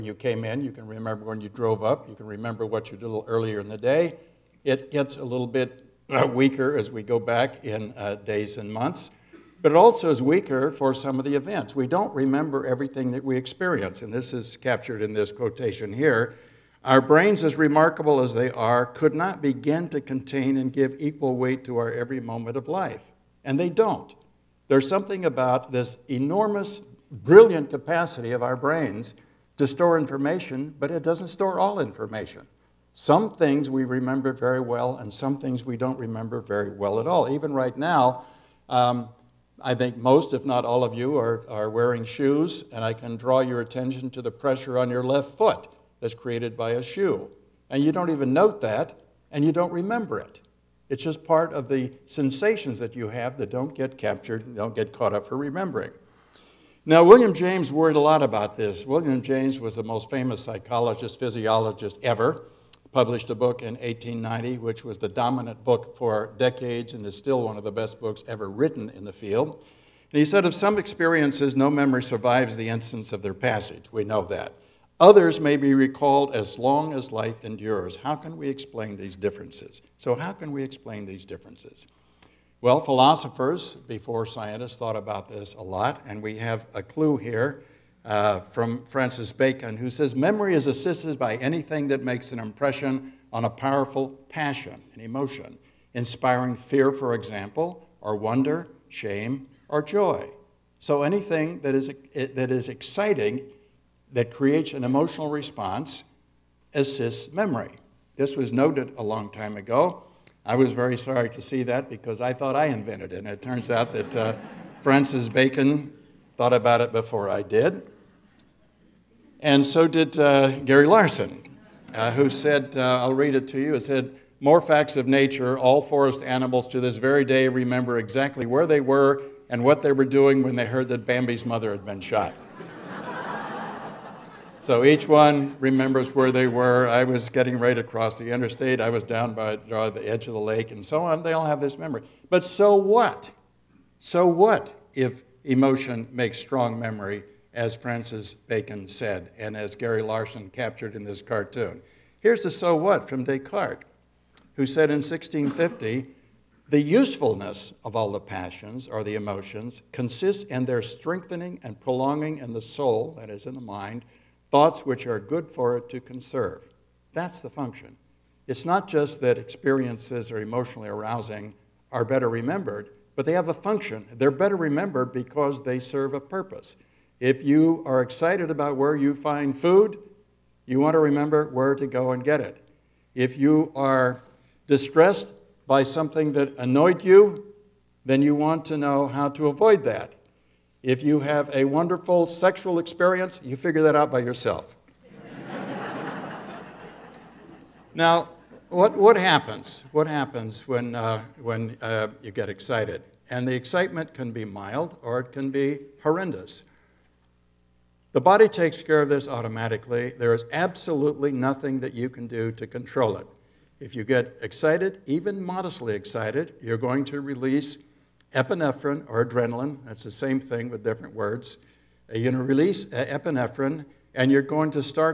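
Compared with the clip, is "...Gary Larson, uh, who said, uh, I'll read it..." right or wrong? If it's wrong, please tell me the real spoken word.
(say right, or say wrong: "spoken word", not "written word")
right.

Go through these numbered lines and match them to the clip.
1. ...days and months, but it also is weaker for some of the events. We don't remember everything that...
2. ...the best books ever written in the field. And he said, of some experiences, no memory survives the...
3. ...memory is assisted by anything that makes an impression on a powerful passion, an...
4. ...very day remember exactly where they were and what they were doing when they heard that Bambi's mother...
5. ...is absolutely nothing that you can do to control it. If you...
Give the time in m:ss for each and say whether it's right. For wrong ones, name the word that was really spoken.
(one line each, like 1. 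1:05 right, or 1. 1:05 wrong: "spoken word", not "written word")
1. 0:08 right
2. 1:07 right
3. 1:30 right
4. 2:06 right
5. 3:30 right.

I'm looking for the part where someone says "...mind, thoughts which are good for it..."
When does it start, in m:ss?
2:43.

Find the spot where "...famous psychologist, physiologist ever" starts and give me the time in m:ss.
1:00.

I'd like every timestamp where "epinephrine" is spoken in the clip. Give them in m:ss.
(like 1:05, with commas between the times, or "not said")
3:38, 3:43.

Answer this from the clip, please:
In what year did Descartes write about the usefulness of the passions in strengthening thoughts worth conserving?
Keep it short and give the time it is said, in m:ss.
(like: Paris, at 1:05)
1650, at 2:34.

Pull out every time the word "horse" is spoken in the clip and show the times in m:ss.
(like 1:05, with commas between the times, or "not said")
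not said.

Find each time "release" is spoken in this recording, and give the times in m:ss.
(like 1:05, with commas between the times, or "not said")
3:37, 3:42.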